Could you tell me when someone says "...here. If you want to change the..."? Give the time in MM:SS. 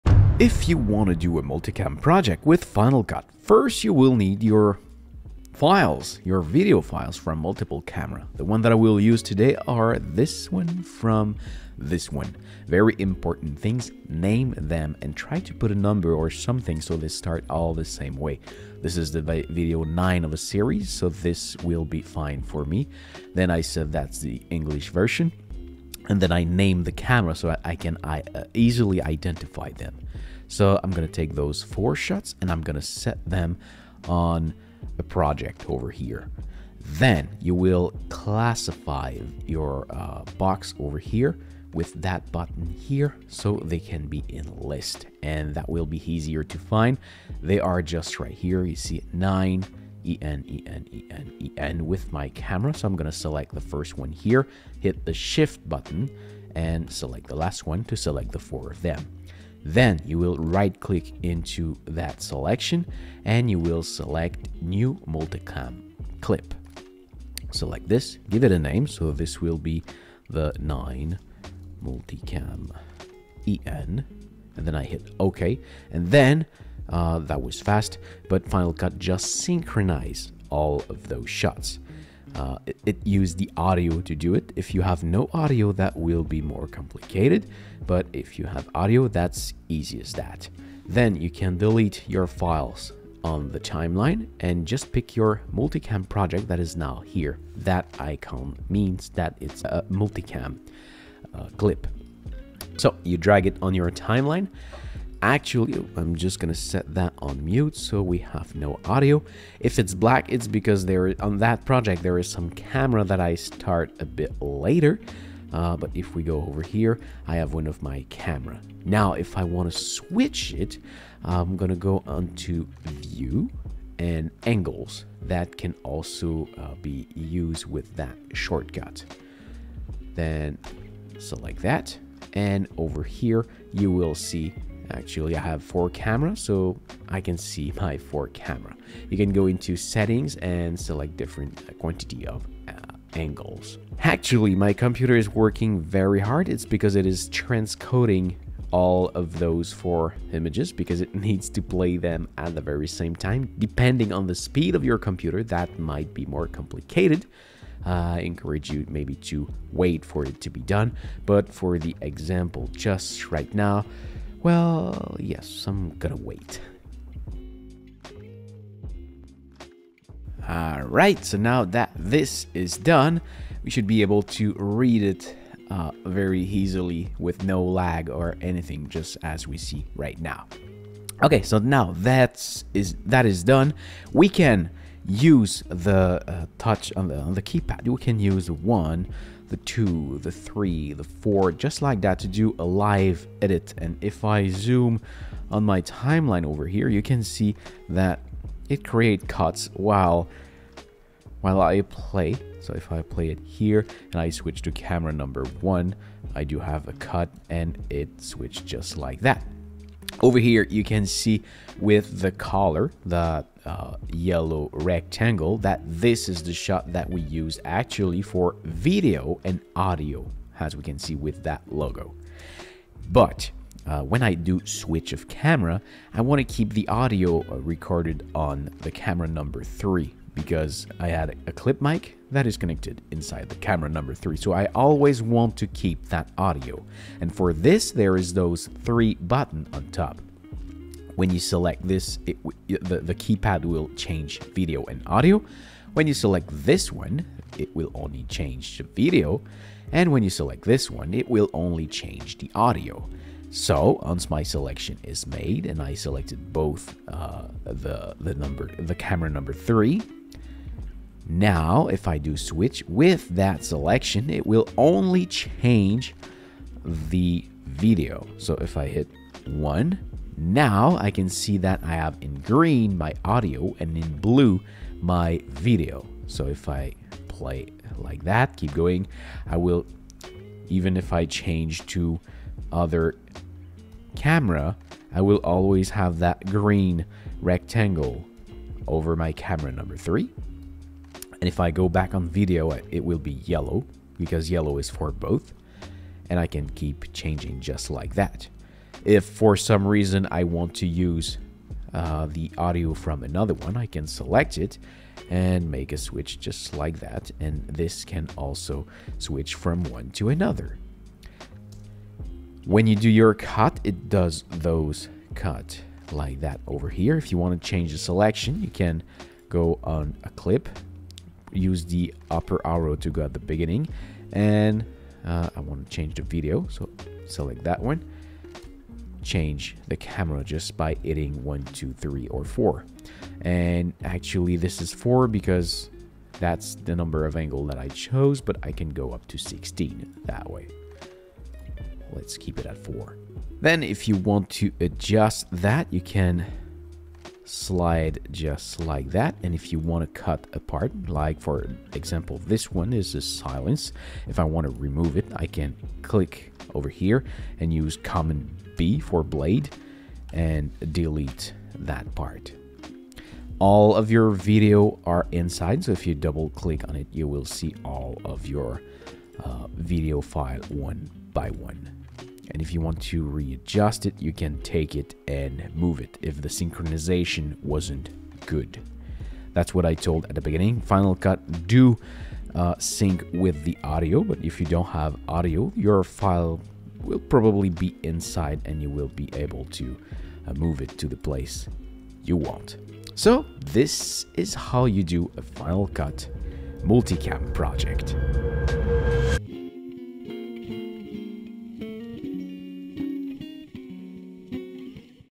05:16.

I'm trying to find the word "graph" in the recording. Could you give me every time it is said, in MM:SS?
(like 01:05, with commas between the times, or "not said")
not said.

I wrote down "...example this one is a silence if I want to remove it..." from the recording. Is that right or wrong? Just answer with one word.
right.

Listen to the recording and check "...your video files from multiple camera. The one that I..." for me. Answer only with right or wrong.
right.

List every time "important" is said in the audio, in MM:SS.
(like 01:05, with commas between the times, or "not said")
00:12.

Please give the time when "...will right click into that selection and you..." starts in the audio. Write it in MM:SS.
01:00.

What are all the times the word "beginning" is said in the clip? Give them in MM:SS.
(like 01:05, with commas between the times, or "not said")
05:23, 06:20.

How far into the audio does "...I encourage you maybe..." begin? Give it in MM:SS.
02:38.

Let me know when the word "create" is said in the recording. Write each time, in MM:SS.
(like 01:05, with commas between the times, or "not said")
03:18.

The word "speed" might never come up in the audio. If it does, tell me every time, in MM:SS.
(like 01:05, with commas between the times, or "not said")
02:34.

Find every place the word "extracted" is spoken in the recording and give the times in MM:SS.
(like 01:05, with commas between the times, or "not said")
not said.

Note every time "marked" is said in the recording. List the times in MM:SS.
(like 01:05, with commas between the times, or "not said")
not said.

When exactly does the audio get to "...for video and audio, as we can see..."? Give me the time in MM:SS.
03:38.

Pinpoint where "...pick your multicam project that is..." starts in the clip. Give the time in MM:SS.
01:34.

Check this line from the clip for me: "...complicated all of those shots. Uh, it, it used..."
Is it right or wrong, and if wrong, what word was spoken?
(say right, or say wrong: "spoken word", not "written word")
wrong: "synchronized", not "complicated".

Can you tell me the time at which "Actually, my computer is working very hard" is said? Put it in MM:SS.
02:23.